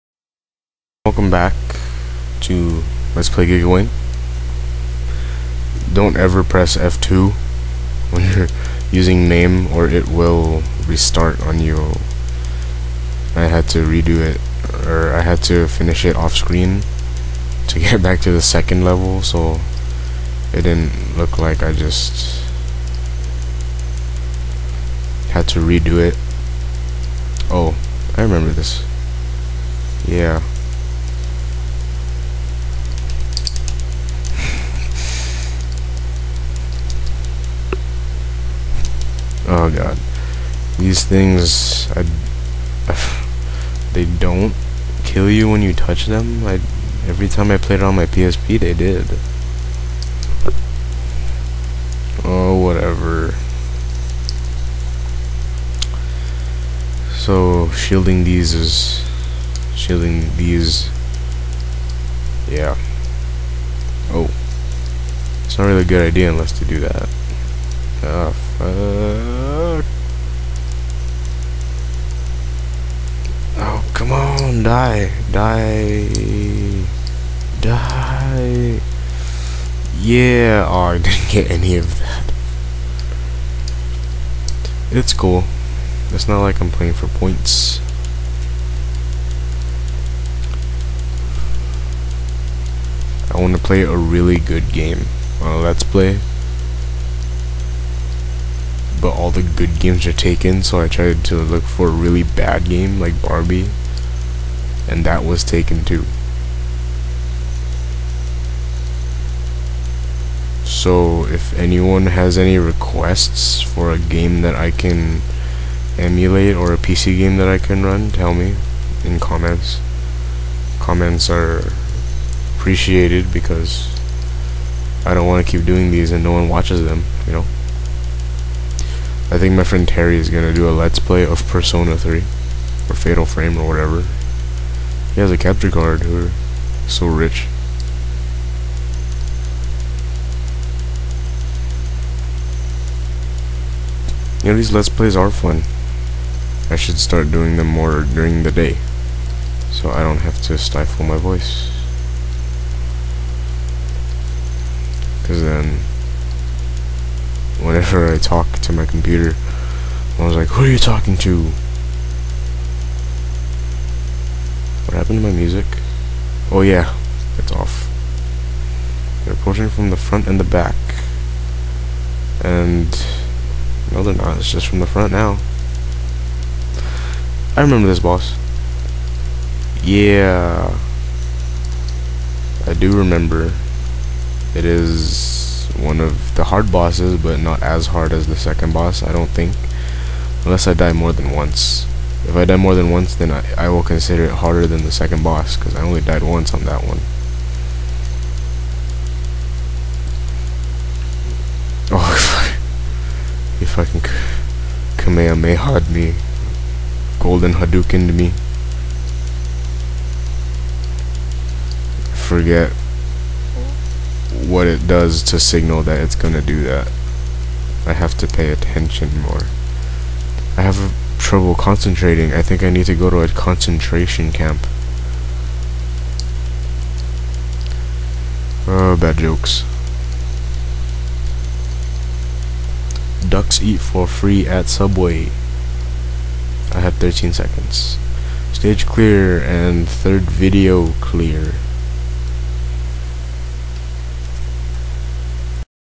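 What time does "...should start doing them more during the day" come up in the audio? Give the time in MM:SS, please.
02:26.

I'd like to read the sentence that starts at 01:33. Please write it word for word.
I want to play a really good game on a Let's Play.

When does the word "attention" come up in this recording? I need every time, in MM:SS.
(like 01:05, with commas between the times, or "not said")
03:38.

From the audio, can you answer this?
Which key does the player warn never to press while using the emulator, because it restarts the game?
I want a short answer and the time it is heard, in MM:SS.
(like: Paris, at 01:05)
F2, at 00:06.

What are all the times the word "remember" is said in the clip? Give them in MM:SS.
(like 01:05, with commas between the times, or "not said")
00:28, 02:57, 03:02.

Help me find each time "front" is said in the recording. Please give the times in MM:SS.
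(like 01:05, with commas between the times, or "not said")
02:49, 02:54.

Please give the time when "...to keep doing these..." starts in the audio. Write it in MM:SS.
02:05.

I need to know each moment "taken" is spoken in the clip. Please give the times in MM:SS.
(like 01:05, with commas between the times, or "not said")
01:40, 01:45.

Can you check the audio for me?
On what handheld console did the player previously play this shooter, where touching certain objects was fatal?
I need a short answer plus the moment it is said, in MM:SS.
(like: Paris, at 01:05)
PSP, at 00:48.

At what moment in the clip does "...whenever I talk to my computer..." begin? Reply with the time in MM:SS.
02:37.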